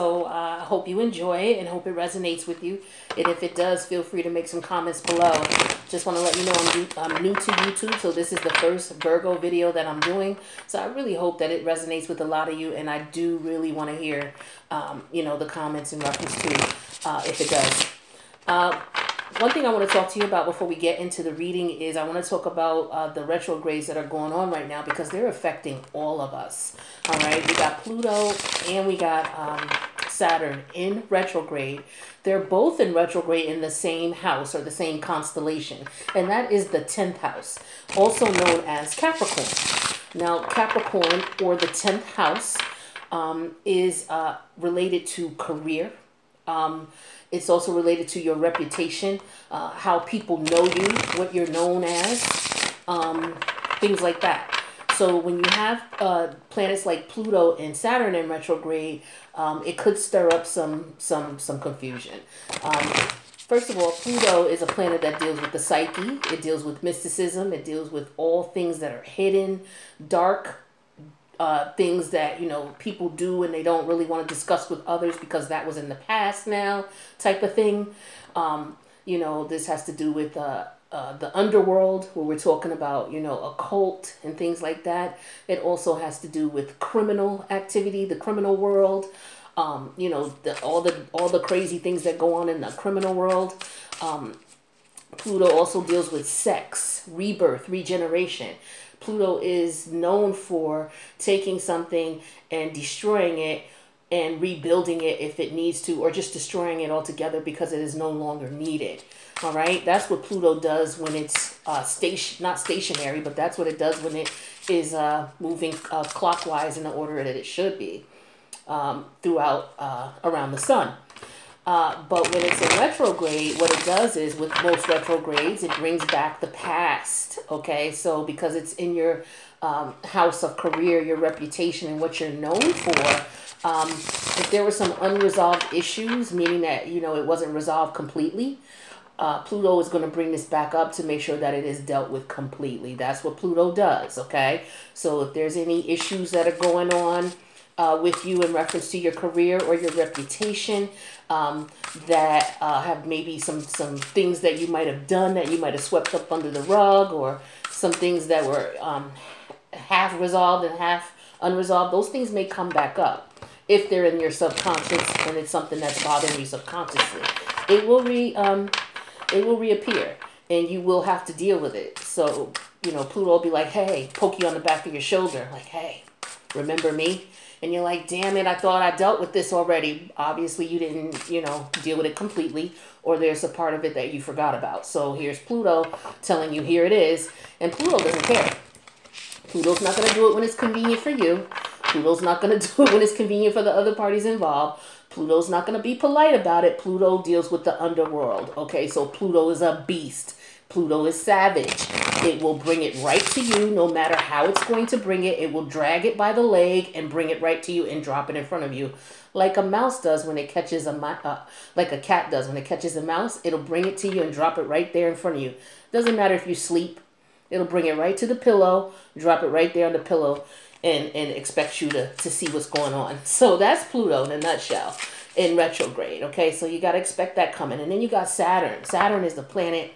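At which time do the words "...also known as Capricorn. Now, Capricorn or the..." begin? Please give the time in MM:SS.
00:37.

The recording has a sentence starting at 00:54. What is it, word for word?
So when you have uh, planets like Pluto and Saturn in retrograde, um, it could stir up some some some confusion.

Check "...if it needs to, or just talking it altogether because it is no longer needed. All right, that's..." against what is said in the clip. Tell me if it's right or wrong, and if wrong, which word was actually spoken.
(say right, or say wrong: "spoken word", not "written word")
wrong: "destroying", not "talking".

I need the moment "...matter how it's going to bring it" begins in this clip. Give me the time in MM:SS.
03:23.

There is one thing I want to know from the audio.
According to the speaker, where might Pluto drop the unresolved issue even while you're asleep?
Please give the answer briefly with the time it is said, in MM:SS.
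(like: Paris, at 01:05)
On the pillow, at 03:39.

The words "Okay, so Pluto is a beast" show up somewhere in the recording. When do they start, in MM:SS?
03:18.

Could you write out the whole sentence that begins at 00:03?
And if it does, feel free to make some comments below.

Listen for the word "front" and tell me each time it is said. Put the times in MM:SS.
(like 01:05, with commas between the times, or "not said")
03:28, 03:35.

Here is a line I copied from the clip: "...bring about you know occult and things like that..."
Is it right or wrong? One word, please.
wrong.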